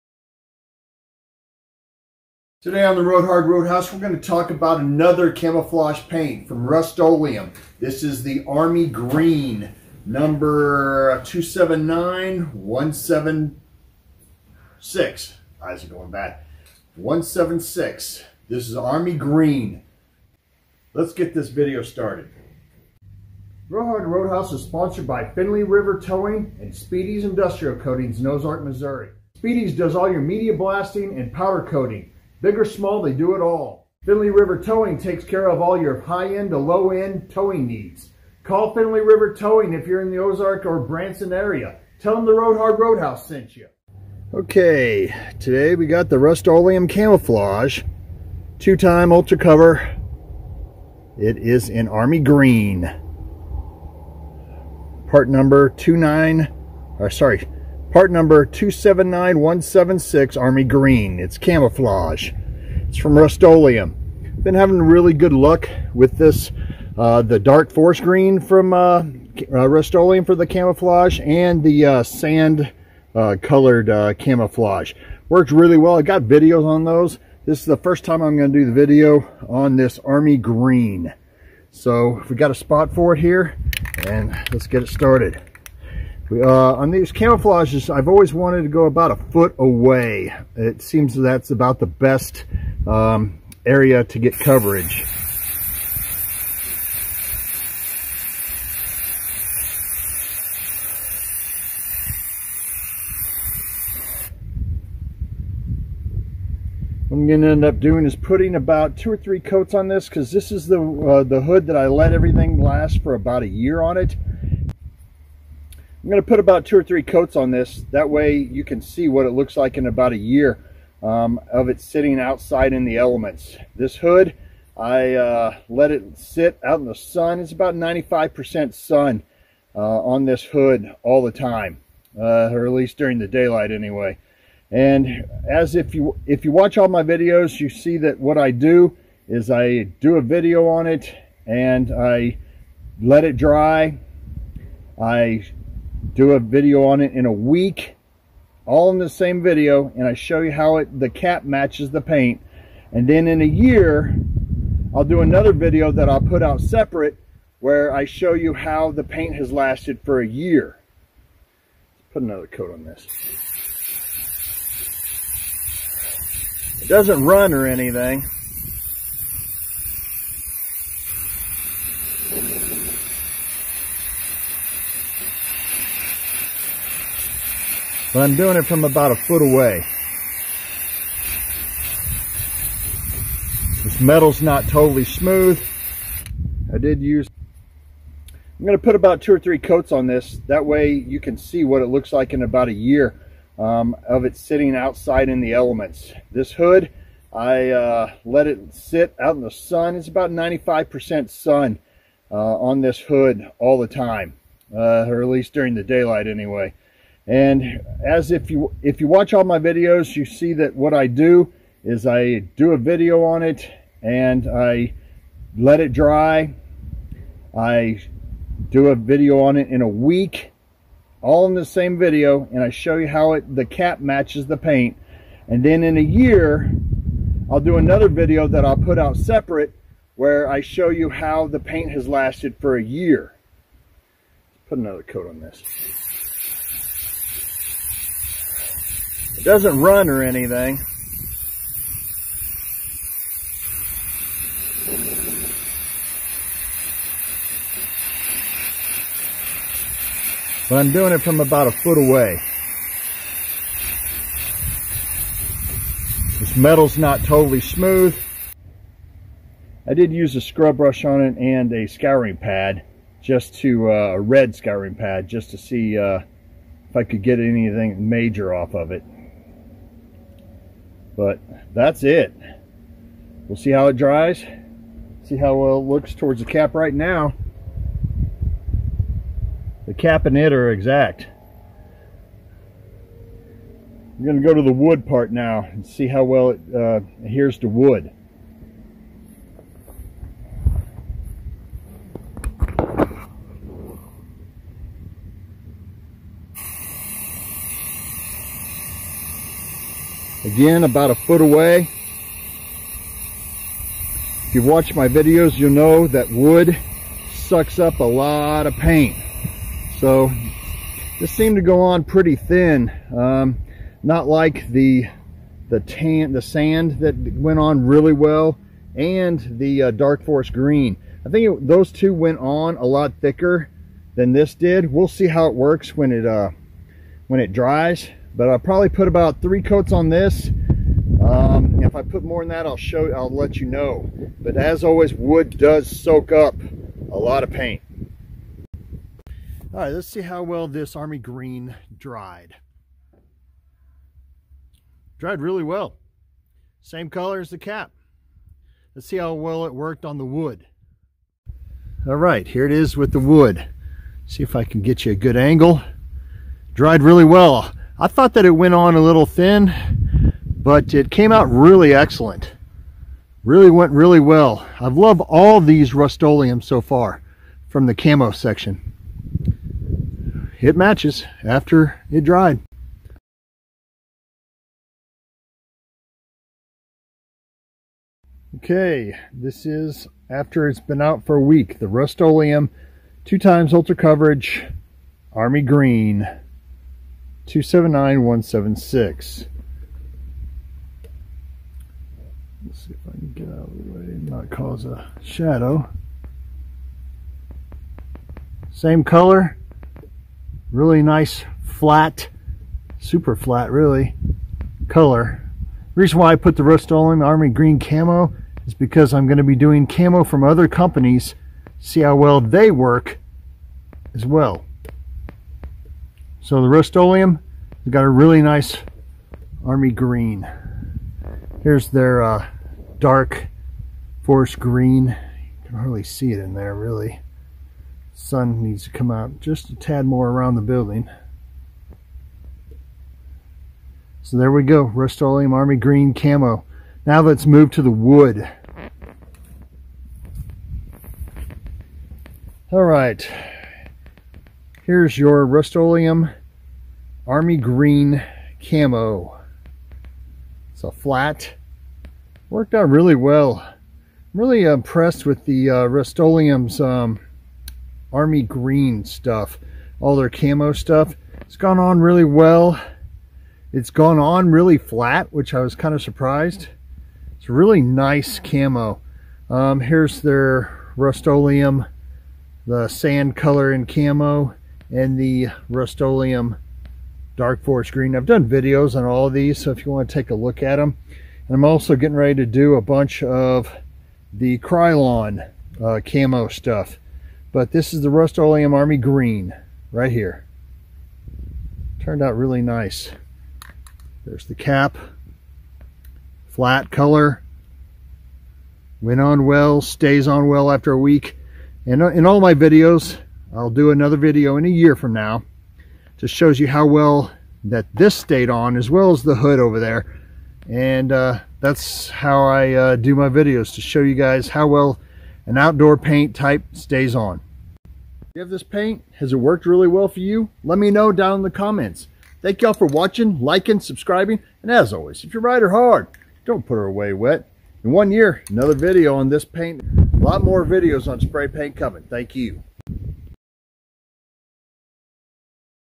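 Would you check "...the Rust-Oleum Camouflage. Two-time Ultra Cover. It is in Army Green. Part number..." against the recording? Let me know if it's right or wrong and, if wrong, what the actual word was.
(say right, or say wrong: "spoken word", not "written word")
right.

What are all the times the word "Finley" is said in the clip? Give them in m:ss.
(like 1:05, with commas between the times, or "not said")
0:25, 0:34, 0:38.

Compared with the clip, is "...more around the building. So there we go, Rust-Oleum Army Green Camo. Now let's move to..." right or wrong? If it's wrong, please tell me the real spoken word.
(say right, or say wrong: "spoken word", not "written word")
right.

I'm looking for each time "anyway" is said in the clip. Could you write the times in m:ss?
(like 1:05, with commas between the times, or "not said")
2:13, 3:26.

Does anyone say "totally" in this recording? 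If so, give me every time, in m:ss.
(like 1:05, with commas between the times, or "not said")
3:04, 4:17.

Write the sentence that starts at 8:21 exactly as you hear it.
And uh, in all my videos, I'll do another video in a year from now.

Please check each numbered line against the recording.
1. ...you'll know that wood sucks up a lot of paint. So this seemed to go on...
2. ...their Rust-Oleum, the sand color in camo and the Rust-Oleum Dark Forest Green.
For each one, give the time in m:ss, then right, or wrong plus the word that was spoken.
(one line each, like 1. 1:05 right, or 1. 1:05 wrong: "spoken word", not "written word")
1. 5:05 right
2. 7:50 right.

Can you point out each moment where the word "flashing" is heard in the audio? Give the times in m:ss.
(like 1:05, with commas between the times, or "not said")
not said.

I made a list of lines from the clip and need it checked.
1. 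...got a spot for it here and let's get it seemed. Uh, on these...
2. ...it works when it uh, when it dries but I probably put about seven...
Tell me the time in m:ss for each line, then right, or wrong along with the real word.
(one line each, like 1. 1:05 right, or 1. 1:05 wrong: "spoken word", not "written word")
1. 1:22 wrong: "started", not "seemed"
2. 5:25 wrong: "three", not "seven".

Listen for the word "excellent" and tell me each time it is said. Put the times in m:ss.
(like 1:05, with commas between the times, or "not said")
6:01.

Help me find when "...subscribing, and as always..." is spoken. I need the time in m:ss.
8:43.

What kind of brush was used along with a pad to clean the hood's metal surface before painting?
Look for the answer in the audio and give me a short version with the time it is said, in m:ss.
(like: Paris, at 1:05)
Scrub brush, at 4:20.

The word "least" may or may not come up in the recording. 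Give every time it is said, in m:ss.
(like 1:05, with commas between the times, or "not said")
2:12, 3:25.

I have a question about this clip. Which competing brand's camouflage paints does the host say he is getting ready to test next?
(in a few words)
Krylon.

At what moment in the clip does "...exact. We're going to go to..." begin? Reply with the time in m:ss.
4:40.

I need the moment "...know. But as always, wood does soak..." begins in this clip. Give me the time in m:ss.
5:33.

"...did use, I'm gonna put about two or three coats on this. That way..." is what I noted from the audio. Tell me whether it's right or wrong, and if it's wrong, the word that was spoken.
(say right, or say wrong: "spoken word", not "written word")
right.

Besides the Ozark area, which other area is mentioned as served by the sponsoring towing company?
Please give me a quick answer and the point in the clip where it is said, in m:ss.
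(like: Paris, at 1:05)
Branson, at 0:40.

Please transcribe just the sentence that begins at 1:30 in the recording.
It seems that's about the best um, area to get coverage.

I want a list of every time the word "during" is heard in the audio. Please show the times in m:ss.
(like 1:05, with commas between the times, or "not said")
2:12, 3:25.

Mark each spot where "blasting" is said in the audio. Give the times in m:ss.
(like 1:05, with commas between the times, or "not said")
0:30.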